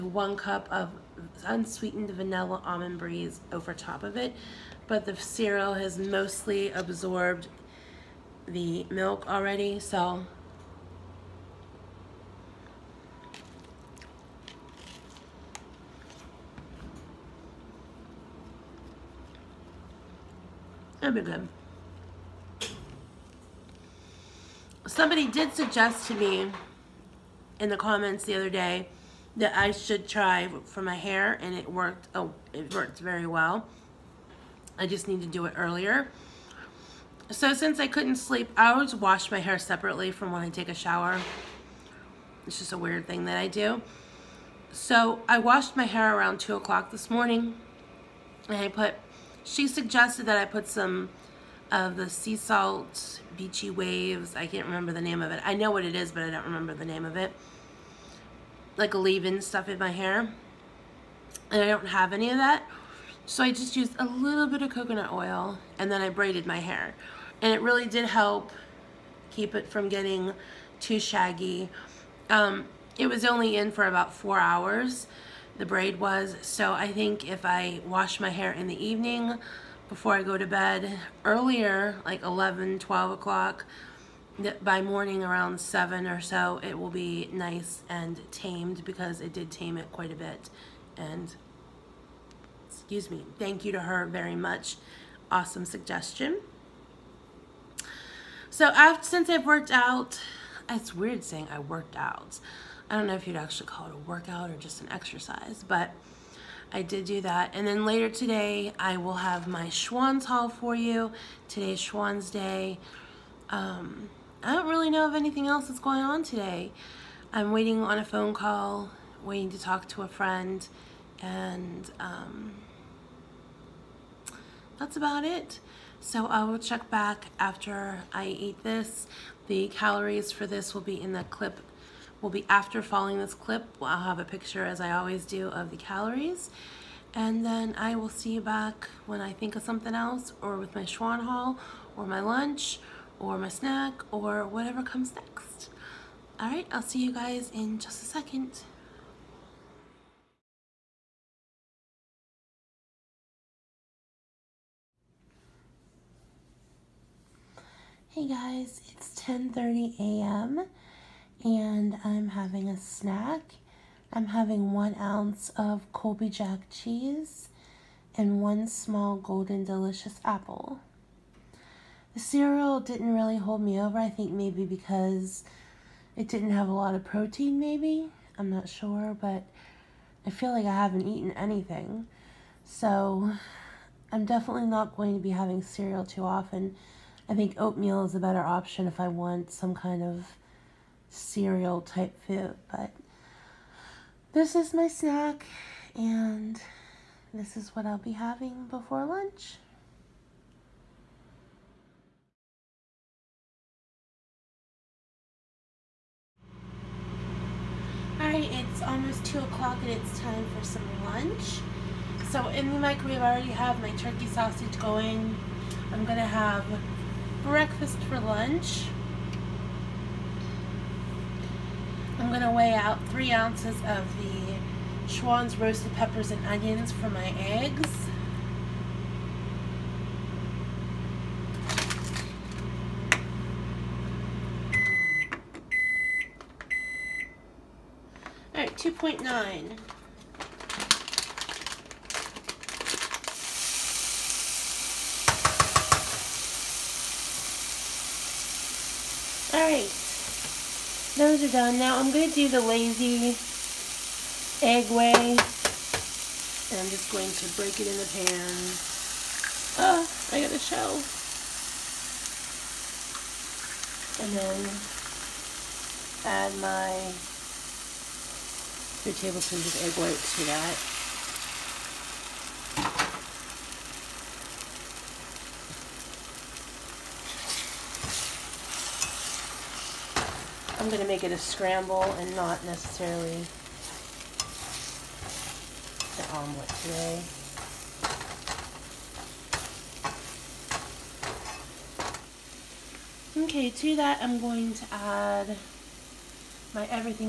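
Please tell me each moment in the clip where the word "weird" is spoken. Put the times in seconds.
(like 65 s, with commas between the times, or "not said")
42 s, 100 s.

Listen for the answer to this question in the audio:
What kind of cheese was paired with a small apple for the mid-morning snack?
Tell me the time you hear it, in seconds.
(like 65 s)
165 s.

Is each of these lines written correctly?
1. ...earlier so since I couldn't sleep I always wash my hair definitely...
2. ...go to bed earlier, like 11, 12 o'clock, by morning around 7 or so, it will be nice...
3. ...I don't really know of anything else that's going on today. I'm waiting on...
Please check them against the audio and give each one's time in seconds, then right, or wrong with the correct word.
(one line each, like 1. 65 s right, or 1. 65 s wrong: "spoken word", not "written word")
1. 35 s wrong: "separately", not "definitely"
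2. 80 s right
3. 114 s right.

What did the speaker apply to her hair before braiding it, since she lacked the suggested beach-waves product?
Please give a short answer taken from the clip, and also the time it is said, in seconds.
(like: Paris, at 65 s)
coconut oil, at 64 s.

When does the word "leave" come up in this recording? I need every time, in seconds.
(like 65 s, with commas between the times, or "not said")
58 s.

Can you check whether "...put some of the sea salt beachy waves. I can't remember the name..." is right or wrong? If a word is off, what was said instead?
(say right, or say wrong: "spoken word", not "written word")
right.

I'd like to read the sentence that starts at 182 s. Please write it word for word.
So I'm definitely not going to be having cereal too often.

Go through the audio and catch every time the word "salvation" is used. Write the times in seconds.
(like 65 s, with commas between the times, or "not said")
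not said.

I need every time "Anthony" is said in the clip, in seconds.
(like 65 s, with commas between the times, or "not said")
not said.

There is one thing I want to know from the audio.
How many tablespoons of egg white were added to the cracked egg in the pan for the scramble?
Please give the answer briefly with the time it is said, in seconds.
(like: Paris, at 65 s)
2, at 269 s.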